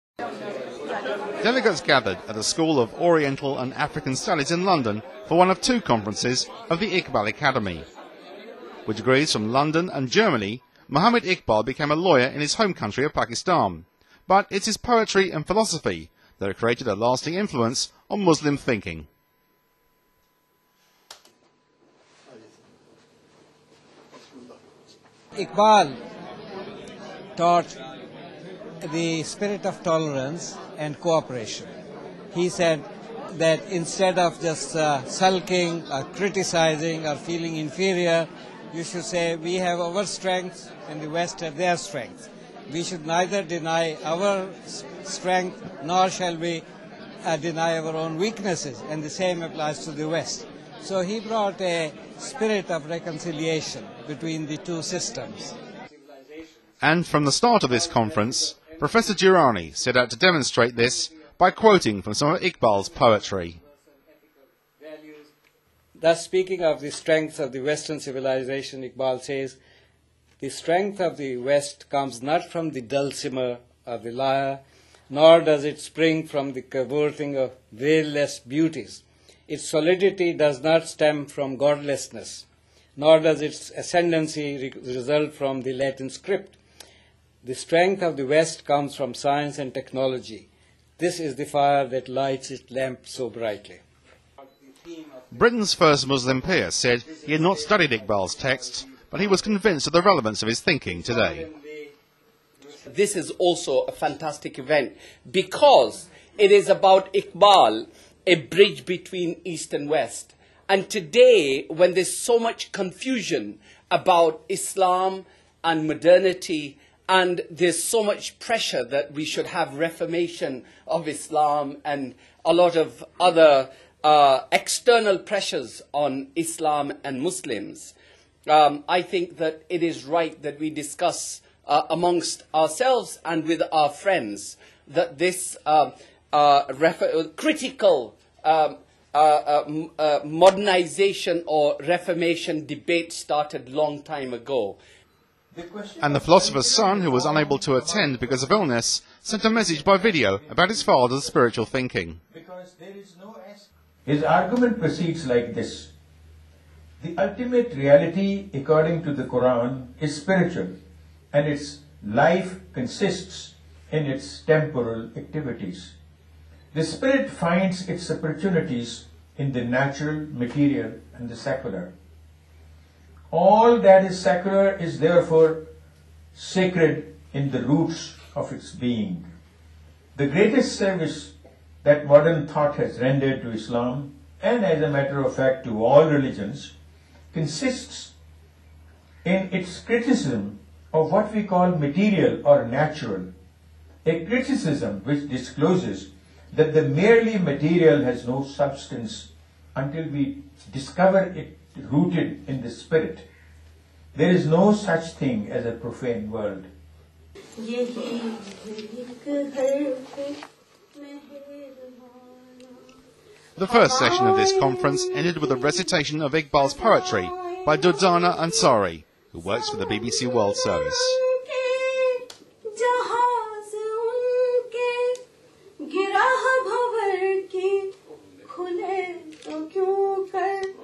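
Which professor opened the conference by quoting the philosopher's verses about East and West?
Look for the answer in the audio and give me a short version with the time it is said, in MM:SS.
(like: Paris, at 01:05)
Professor Girani, at 00:58.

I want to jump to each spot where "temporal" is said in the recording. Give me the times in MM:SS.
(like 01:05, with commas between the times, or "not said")
02:44.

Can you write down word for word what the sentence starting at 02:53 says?
All that is secular is therefore sacred in the roots of its being.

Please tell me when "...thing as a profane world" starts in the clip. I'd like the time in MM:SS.
03:25.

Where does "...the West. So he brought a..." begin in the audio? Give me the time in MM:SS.
00:49.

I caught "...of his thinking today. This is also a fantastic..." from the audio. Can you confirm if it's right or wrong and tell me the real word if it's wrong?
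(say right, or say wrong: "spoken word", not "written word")
right.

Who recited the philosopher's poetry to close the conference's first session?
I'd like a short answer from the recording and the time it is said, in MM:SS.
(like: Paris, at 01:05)
Durdana Ansari, at 03:37.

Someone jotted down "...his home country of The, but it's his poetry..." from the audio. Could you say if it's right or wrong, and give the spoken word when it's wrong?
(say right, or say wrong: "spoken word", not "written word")
wrong: "Pakistan", not "The".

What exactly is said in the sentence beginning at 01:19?
Its solidity does not stem from godlessness, nor does its ascendancy re result from the Latin script.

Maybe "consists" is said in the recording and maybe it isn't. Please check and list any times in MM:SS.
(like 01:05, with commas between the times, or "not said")
02:42, 03:07.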